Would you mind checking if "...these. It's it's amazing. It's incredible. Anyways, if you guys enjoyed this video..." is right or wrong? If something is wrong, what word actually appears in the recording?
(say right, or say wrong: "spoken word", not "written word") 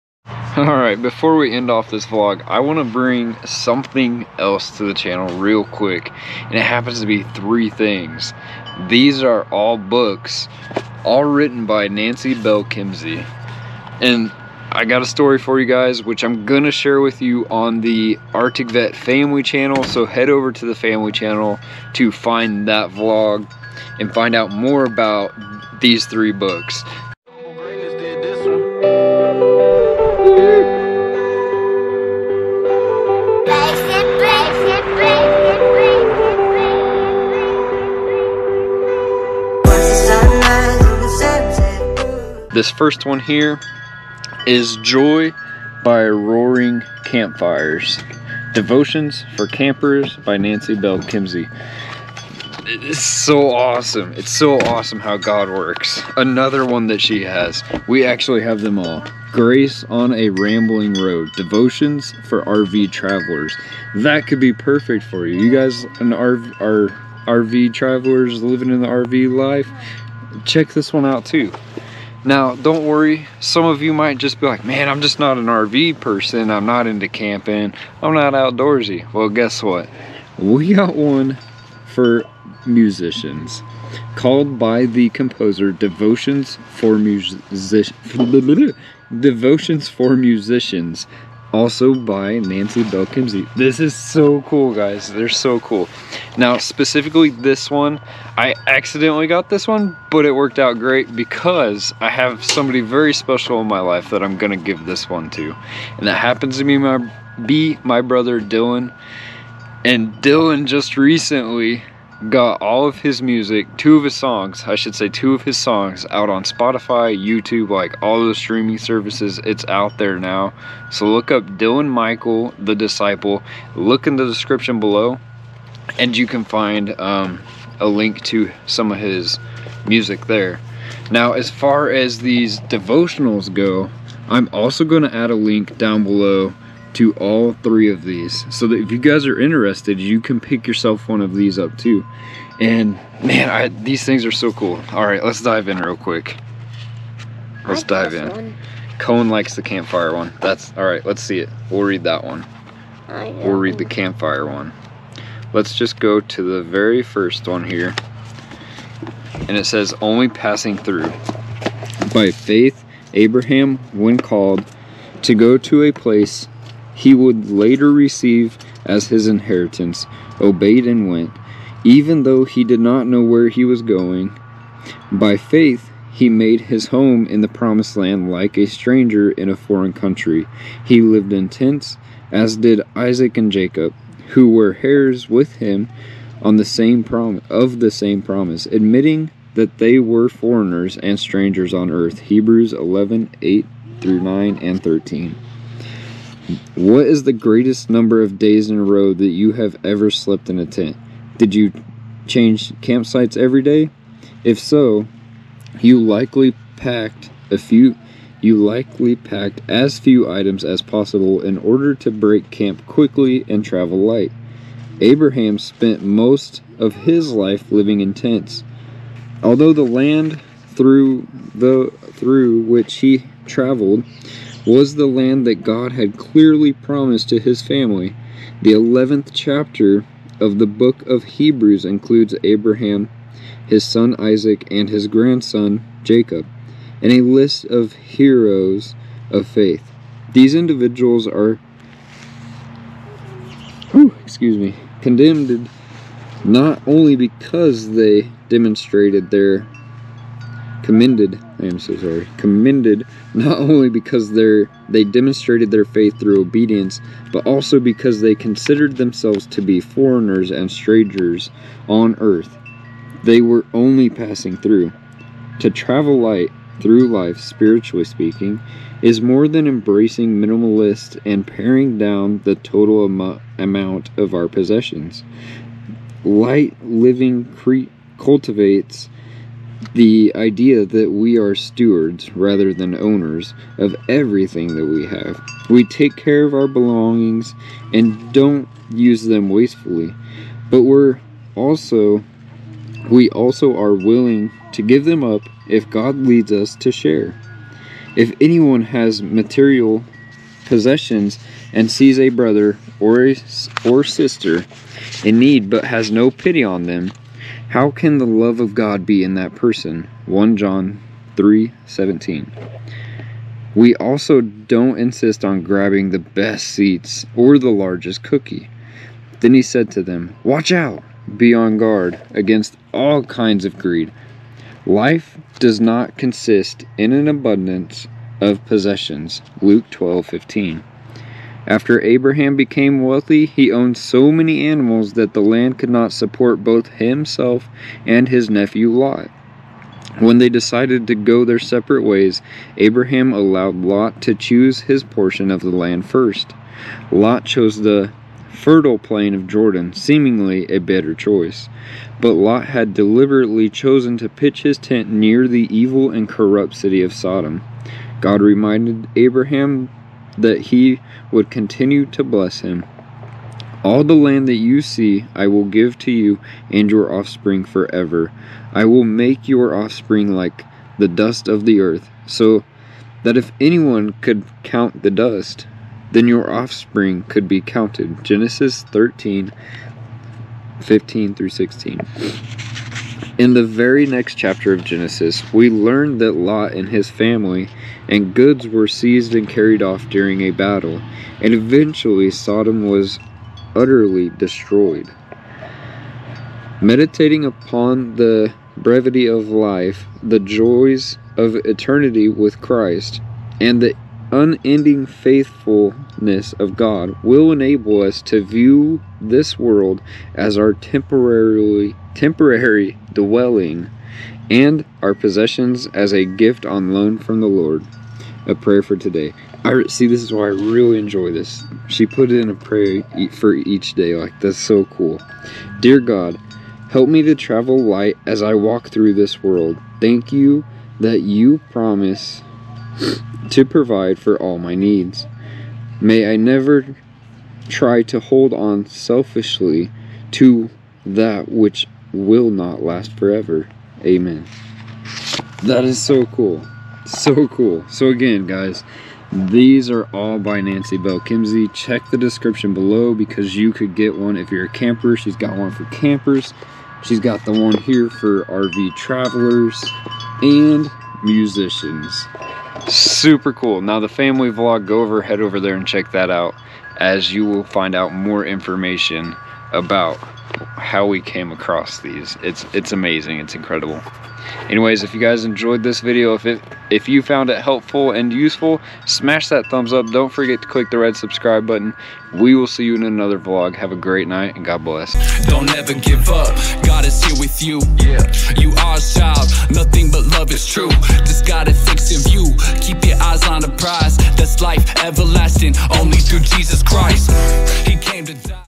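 right.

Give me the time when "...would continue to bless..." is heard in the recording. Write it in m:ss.
6:01.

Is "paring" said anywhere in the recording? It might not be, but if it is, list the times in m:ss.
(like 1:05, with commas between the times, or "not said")
4:31.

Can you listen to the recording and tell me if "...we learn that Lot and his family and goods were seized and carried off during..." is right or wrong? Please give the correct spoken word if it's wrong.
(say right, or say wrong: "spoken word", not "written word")
right.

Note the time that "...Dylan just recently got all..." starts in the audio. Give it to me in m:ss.
1:50.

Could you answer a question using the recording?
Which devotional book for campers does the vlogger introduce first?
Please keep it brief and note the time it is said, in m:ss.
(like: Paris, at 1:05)
Joy by Roaring Campfires, at 0:44.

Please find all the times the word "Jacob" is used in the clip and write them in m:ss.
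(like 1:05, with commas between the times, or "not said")
3:03, 3:56.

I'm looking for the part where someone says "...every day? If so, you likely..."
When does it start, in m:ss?
3:23.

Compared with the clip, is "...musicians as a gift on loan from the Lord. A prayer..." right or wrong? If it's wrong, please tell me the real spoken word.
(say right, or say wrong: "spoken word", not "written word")
wrong: "possessions", not "musicians".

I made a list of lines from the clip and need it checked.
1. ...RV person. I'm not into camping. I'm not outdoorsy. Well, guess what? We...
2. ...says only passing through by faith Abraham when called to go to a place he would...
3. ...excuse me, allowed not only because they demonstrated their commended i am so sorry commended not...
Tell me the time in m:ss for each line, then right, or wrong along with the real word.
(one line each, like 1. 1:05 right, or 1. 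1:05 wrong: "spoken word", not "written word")
1. 1:15 right
2. 2:39 right
3. 4:04 wrong: "condemned", not "allowed".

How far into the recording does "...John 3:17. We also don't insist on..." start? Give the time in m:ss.
5:10.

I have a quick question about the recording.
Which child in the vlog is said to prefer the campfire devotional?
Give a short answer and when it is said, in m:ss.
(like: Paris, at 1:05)
Cohen, at 2:28.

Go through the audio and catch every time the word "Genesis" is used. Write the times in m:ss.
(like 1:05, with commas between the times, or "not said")
6:18, 6:24.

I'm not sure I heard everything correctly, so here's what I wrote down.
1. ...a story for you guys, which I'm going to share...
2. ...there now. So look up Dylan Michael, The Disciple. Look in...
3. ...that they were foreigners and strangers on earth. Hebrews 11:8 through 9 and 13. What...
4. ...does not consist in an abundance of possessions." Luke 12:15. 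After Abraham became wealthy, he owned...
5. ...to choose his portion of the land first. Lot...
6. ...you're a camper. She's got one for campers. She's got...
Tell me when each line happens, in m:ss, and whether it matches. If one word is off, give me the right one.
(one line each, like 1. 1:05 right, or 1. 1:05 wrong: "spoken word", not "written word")
1. 0:15 right
2. 1:59 right
3. 3:09 right
4. 5:25 right
5. 5:44 right
6. 7:34 right.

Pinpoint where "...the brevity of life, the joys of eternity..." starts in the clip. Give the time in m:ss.
6:38.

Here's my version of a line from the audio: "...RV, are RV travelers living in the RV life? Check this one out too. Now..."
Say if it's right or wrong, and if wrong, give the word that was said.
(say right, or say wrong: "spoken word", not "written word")
right.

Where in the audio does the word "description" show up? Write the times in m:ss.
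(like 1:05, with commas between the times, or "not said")
2:04, 7:32.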